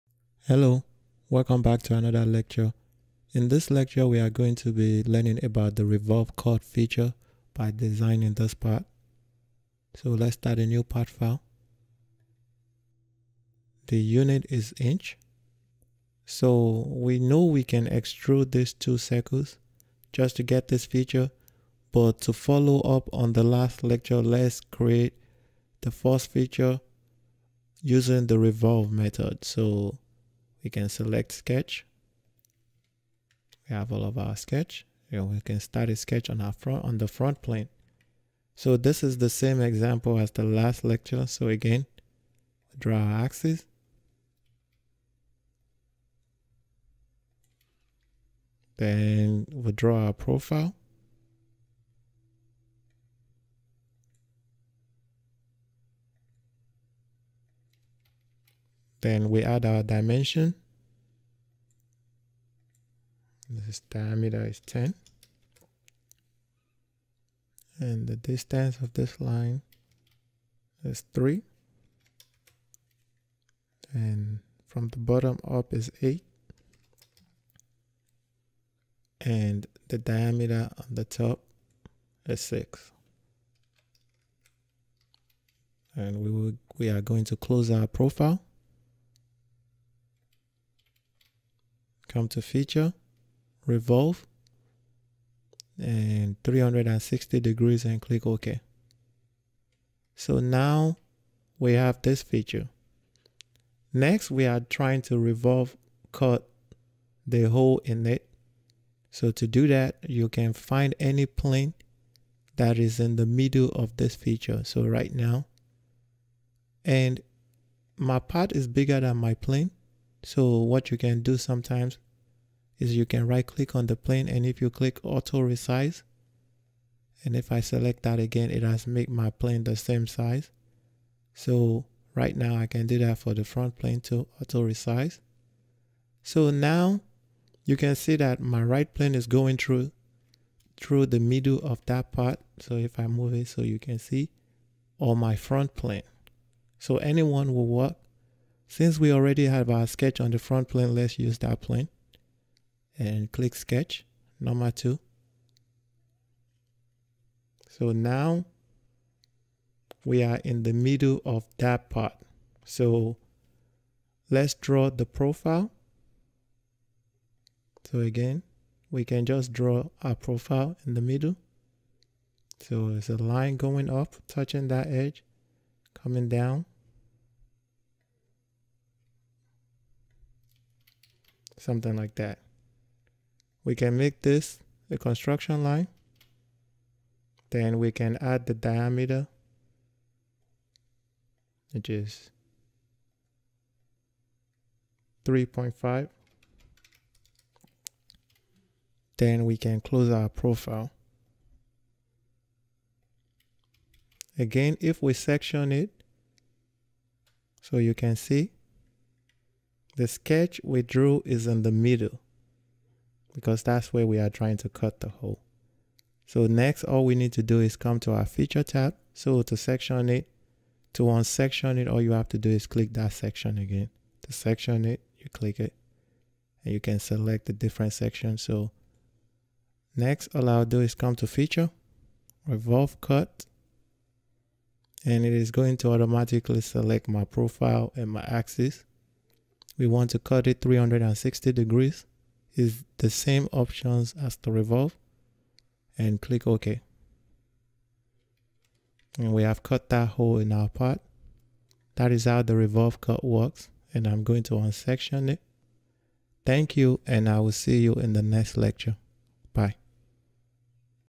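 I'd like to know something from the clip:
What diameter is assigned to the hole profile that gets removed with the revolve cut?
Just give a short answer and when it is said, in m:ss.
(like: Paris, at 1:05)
3.5, at 3:11.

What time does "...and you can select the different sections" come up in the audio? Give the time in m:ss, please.
3:46.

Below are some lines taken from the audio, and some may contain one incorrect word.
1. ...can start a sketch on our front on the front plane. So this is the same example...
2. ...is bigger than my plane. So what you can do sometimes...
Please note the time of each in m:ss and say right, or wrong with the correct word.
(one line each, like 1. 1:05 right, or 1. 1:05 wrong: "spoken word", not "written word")
1. 0:35 right
2. 1:58 right.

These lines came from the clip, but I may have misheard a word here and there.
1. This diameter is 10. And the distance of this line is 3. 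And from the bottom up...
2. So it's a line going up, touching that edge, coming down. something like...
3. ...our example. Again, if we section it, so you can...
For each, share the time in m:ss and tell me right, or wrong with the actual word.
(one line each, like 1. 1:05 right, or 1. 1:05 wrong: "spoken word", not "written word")
1. 1:03 right
2. 2:52 right
3. 3:20 wrong: "profile", not "example".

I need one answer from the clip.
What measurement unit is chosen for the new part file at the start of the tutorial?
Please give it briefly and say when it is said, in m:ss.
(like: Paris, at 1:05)
inch, at 0:13.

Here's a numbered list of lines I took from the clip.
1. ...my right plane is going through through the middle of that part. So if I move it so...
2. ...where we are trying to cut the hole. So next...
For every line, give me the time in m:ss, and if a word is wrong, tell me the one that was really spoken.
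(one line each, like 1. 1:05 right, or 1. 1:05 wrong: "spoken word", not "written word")
1. 2:18 right
2. 3:33 right.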